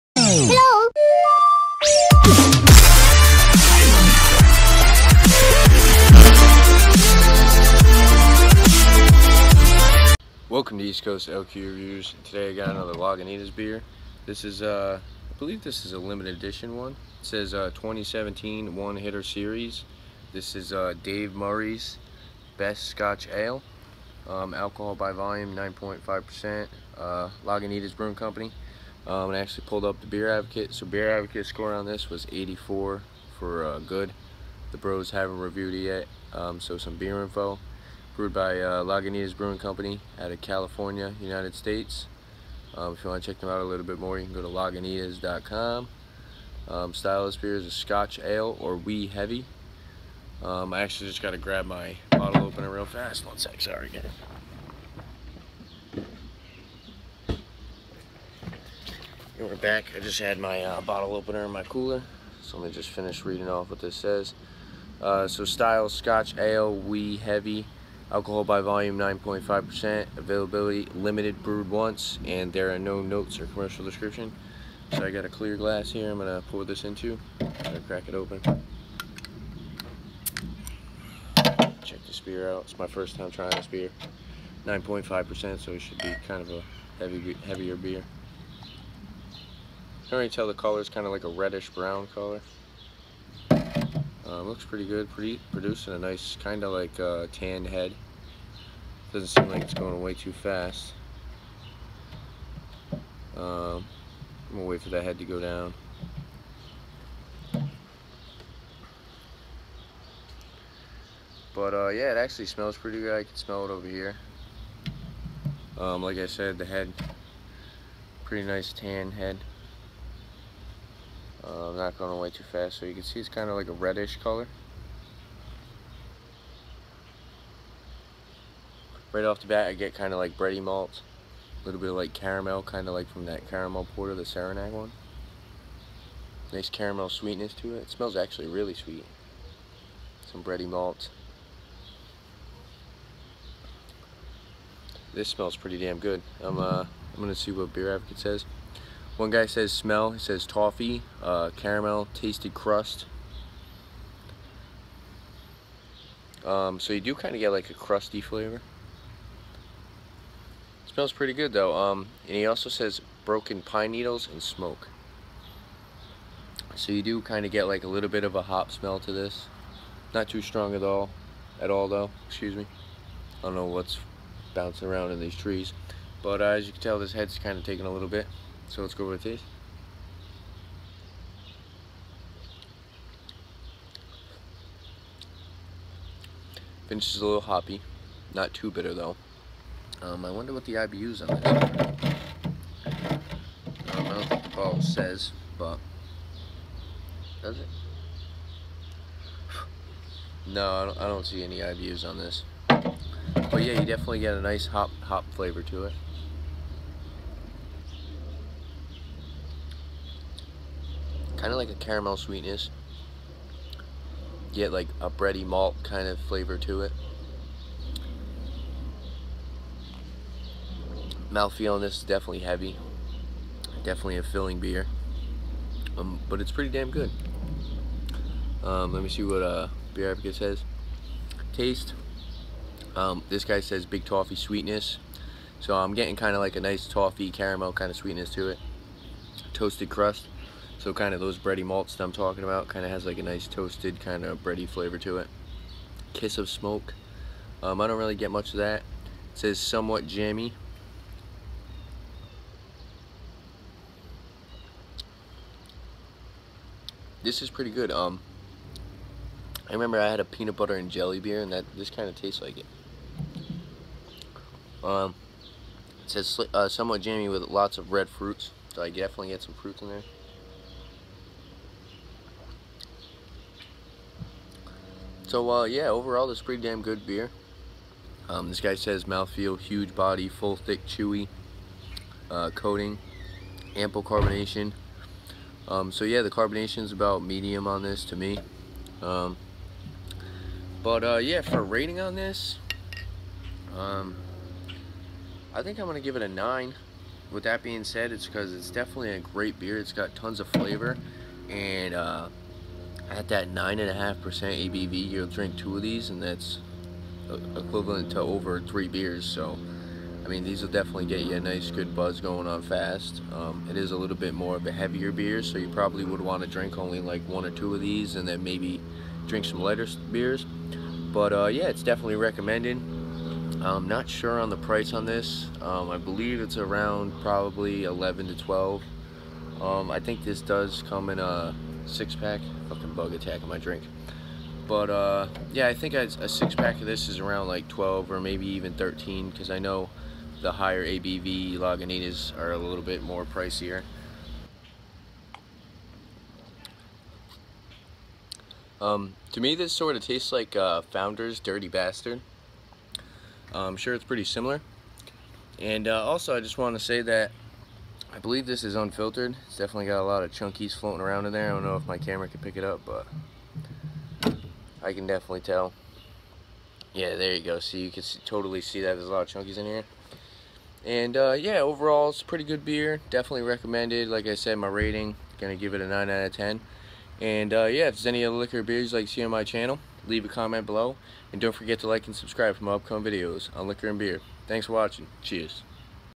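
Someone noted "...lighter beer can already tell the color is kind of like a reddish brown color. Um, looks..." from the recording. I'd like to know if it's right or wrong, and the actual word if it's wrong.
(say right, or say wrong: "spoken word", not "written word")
wrong: "heavier", not "lighter".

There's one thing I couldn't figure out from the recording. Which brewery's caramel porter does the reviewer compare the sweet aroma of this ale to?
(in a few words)
Saranac.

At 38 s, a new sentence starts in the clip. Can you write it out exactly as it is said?
Brewed by uh, Lagunitas Brewing Company out of California, United States.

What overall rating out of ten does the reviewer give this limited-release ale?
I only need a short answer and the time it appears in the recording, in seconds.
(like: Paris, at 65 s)
9, at 296 s.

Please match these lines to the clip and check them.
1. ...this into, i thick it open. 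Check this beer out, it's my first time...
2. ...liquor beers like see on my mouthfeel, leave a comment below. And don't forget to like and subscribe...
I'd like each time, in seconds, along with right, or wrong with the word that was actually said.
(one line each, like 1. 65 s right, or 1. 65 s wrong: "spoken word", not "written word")
1. 76 s wrong: "crack", not "thick"
2. 378 s wrong: "channel", not "mouthfeel".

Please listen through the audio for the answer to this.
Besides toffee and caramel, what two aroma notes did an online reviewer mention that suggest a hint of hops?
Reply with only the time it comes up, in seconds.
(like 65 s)
163 s.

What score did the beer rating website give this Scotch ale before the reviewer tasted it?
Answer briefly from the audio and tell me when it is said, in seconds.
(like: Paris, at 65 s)
84, at 32 s.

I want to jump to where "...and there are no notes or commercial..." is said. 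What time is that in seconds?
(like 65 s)
72 s.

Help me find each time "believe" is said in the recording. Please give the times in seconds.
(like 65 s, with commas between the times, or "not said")
15 s, 325 s, 358 s.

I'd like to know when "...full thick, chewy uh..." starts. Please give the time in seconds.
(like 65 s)
280 s.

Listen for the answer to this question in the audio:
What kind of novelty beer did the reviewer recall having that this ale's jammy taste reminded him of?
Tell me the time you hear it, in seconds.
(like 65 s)
260 s.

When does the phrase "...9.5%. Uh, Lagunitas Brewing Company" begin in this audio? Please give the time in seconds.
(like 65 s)
25 s.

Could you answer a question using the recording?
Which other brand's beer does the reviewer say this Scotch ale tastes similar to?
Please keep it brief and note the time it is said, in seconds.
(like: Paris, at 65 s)
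Founders Dirty Bastard, at 350 s.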